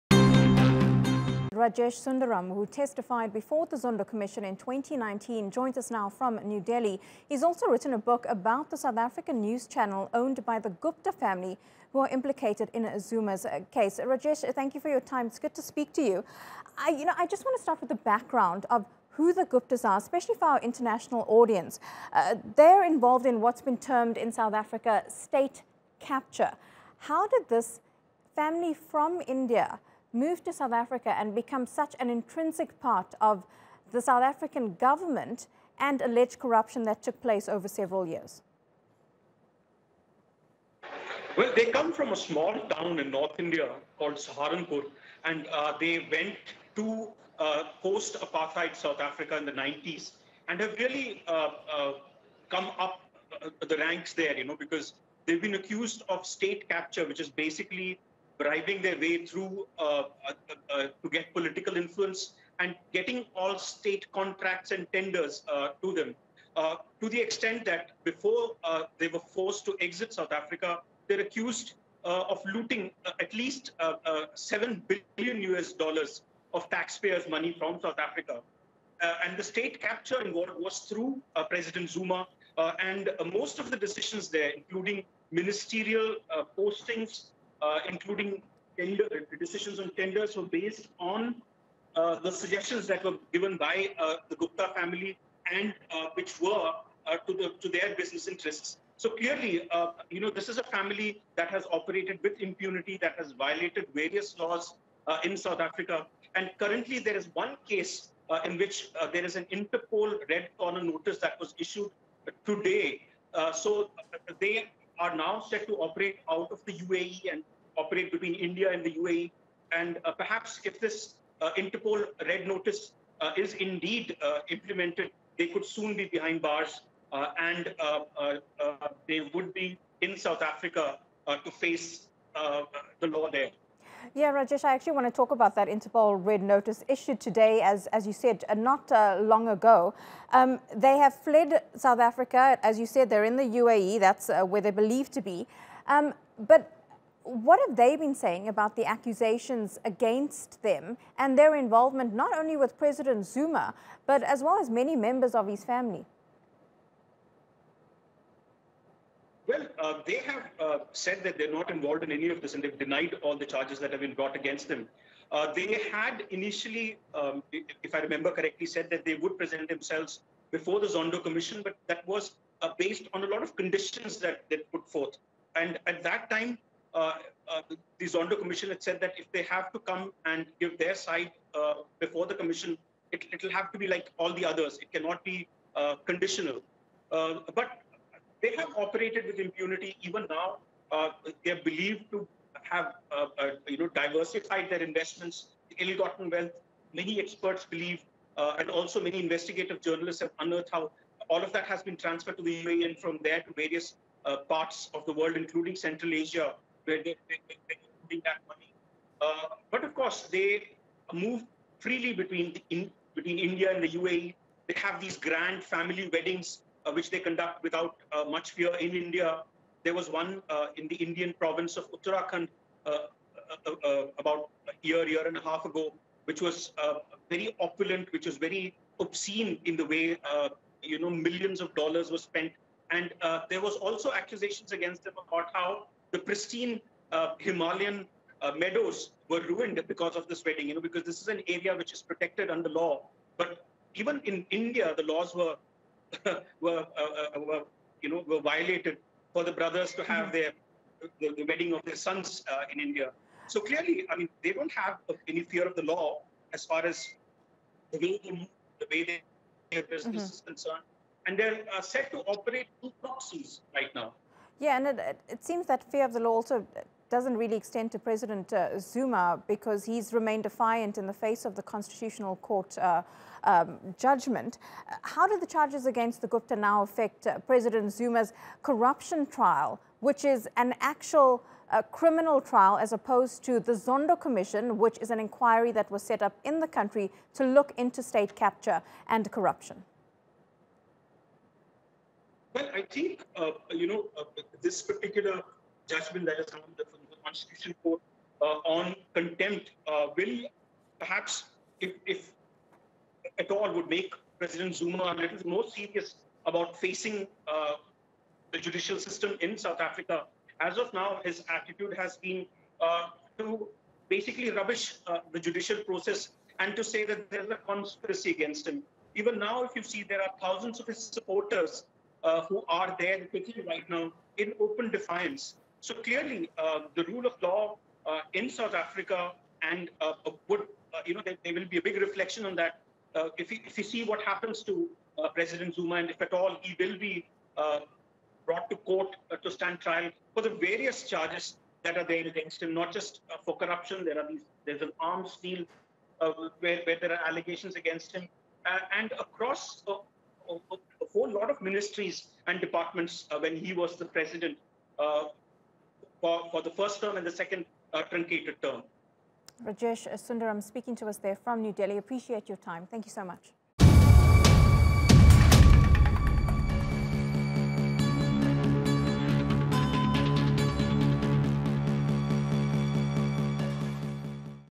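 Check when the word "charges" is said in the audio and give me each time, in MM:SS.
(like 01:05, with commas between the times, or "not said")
02:43, 04:35, 05:41.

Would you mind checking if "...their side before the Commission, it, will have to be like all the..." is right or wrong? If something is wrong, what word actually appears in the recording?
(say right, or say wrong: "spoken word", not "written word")
right.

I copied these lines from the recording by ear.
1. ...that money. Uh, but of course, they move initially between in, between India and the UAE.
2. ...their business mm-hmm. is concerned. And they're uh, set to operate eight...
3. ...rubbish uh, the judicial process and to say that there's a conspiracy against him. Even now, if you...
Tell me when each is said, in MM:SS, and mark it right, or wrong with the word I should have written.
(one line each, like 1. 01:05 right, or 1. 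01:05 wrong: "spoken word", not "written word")
1. 03:28 wrong: "freely", not "initially"
2. 04:19 wrong: "two", not "eight"
3. 05:14 right.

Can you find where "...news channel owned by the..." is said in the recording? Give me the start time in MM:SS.
00:09.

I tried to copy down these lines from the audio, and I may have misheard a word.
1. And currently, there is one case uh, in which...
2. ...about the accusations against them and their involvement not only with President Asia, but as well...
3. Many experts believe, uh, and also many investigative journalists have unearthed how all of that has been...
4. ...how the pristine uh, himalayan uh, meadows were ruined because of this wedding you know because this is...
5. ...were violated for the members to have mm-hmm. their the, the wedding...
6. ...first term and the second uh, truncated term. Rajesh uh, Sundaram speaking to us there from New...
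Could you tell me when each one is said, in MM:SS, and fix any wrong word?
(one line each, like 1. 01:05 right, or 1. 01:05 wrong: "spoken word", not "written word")
1. 01:46 right
2. 02:28 wrong: "Zuma", not "Asia"
3. 03:16 right
4. 03:55 right
5. 04:08 wrong: "brothers", not "members"
6. 05:56 right.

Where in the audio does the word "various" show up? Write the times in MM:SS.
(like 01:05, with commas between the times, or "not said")
01:43, 03:23, 05:40.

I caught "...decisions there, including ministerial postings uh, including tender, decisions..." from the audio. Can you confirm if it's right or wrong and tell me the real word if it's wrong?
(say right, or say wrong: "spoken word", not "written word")
right.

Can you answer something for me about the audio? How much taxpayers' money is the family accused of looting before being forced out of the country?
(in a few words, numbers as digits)
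7 billion US dollars.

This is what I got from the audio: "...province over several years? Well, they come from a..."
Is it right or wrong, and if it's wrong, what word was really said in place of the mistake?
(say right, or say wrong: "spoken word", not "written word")
wrong: "place", not "province".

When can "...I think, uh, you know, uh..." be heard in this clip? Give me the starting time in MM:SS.
04:52.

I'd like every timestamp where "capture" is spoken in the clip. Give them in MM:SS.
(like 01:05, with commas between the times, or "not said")
00:25, 00:56, 01:19, 04:48.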